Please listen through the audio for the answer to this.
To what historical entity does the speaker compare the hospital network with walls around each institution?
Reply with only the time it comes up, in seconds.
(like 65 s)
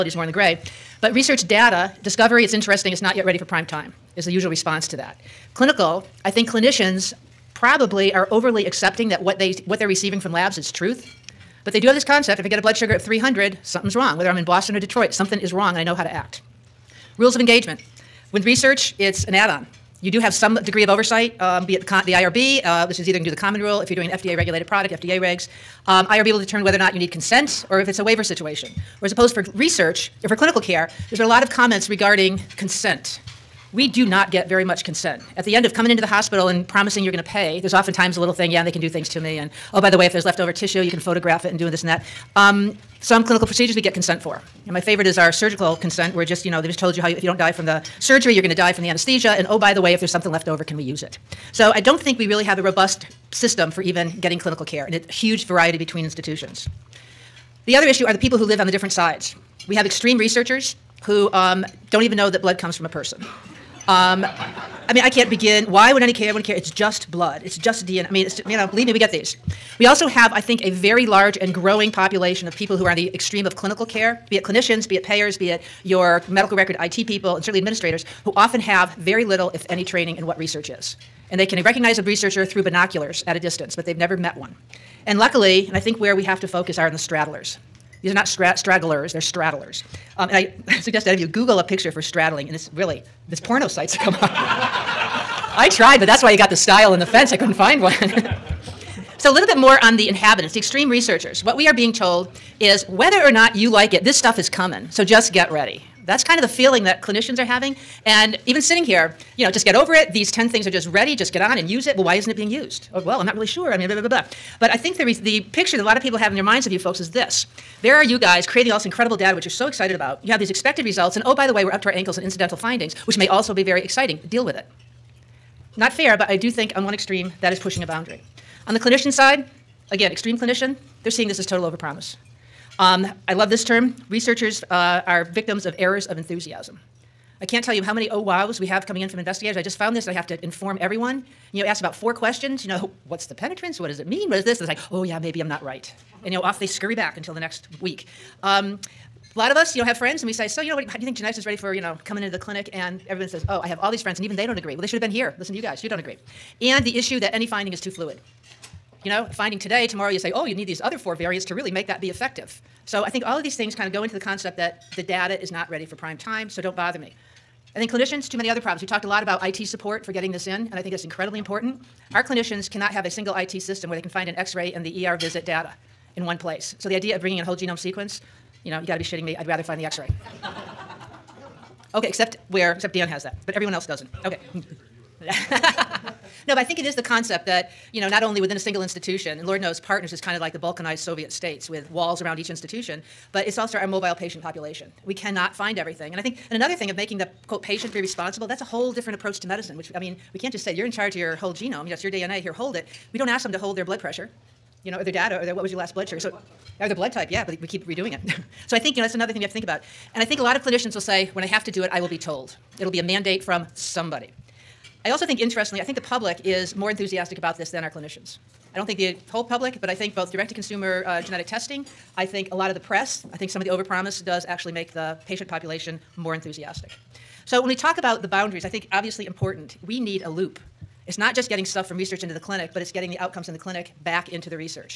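190 s.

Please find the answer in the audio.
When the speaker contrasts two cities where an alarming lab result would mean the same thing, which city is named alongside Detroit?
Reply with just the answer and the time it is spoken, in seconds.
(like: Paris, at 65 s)
Boston, at 14 s.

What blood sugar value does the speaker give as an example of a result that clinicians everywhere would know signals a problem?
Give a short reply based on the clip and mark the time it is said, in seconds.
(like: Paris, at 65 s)
300, at 13 s.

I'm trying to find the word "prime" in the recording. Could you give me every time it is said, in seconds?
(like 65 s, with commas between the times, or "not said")
3 s, 165 s.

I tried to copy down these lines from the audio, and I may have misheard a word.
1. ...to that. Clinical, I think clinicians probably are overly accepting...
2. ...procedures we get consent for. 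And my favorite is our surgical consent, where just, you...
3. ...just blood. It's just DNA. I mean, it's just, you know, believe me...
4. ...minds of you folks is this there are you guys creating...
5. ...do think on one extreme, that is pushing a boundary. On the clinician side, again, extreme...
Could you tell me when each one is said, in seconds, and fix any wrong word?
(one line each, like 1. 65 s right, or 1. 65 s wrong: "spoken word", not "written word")
1. 4 s right
2. 43 s right
3. 66 s right
4. 116 s right
5. 126 s right.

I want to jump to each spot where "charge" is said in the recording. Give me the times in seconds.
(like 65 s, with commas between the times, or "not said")
200 s.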